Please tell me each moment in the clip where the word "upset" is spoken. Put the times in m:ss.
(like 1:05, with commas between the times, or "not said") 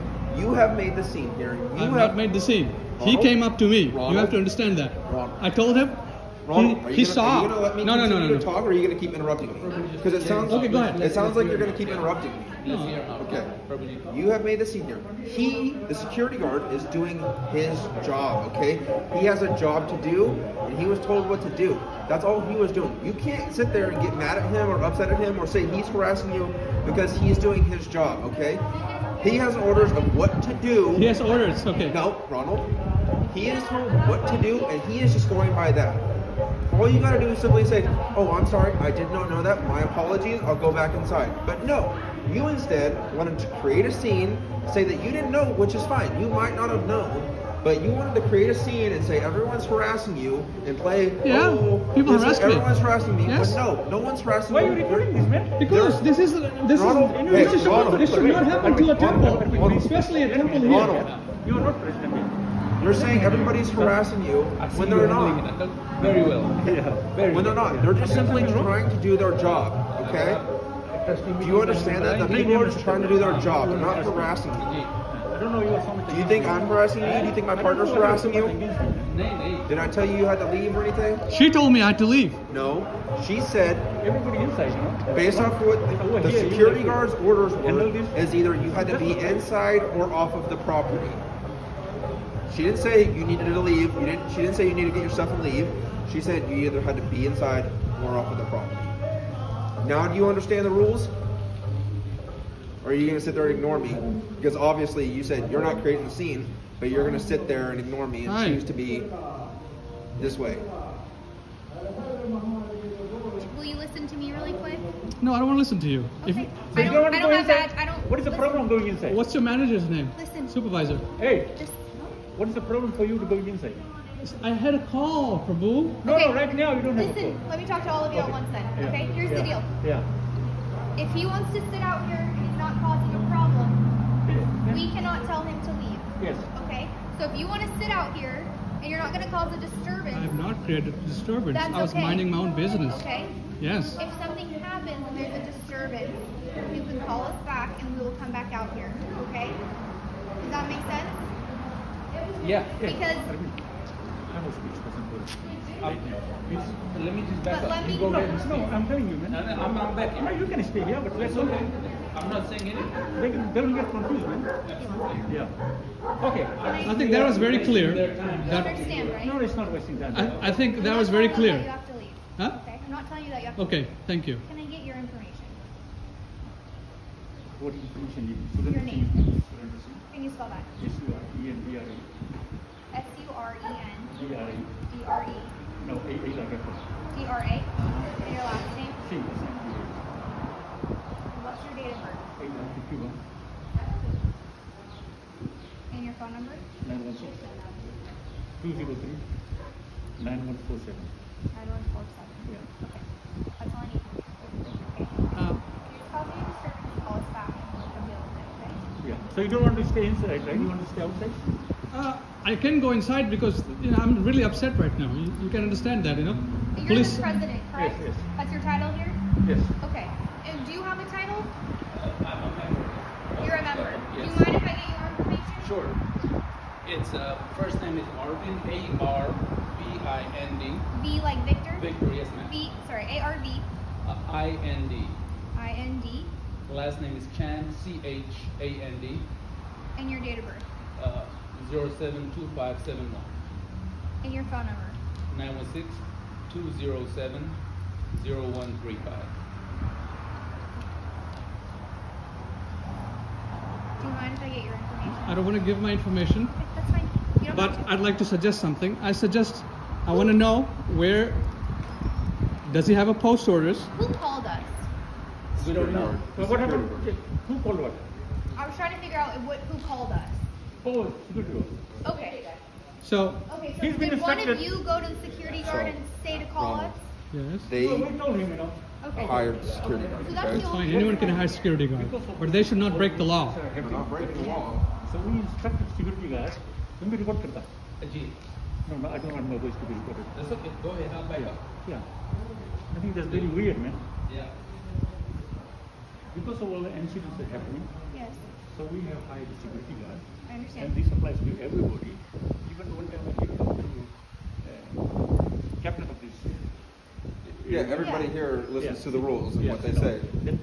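0:24, 3:34.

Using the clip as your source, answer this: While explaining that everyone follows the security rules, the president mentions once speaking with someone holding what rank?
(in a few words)
Captain.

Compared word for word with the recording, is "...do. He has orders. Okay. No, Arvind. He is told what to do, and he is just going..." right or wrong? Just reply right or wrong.
wrong.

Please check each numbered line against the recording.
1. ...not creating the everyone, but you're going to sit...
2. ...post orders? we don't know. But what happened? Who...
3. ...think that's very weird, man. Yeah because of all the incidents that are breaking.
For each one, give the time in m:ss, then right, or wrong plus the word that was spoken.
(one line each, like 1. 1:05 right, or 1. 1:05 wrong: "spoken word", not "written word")
1. 1:45 wrong: "scene", not "everyone"
2. 4:23 right
3. 4:52 wrong: "happening", not "breaking".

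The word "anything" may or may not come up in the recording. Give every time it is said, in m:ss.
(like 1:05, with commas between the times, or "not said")
1:20, 2:42.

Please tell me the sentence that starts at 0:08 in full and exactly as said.
talk, or are you gonna keep interrupting me?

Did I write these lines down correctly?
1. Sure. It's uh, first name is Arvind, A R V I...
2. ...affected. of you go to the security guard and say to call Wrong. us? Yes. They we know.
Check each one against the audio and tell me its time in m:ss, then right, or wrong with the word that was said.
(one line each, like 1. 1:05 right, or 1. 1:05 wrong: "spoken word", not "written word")
1. 3:45 right
2. 4:34 right.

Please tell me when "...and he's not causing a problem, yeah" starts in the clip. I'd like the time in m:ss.
2:12.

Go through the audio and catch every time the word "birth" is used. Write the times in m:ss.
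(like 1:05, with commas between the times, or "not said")
3:11, 4:00.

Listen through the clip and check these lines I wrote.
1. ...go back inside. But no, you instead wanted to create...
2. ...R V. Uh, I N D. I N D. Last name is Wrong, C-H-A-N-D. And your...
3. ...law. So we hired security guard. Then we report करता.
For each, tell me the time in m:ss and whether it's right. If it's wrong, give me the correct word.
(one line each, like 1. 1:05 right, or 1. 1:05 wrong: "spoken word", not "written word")
1. 0:40 right
2. 3:53 wrong: "Chand", not "Wrong"
3. 4:44 wrong: "instructed", not "hired".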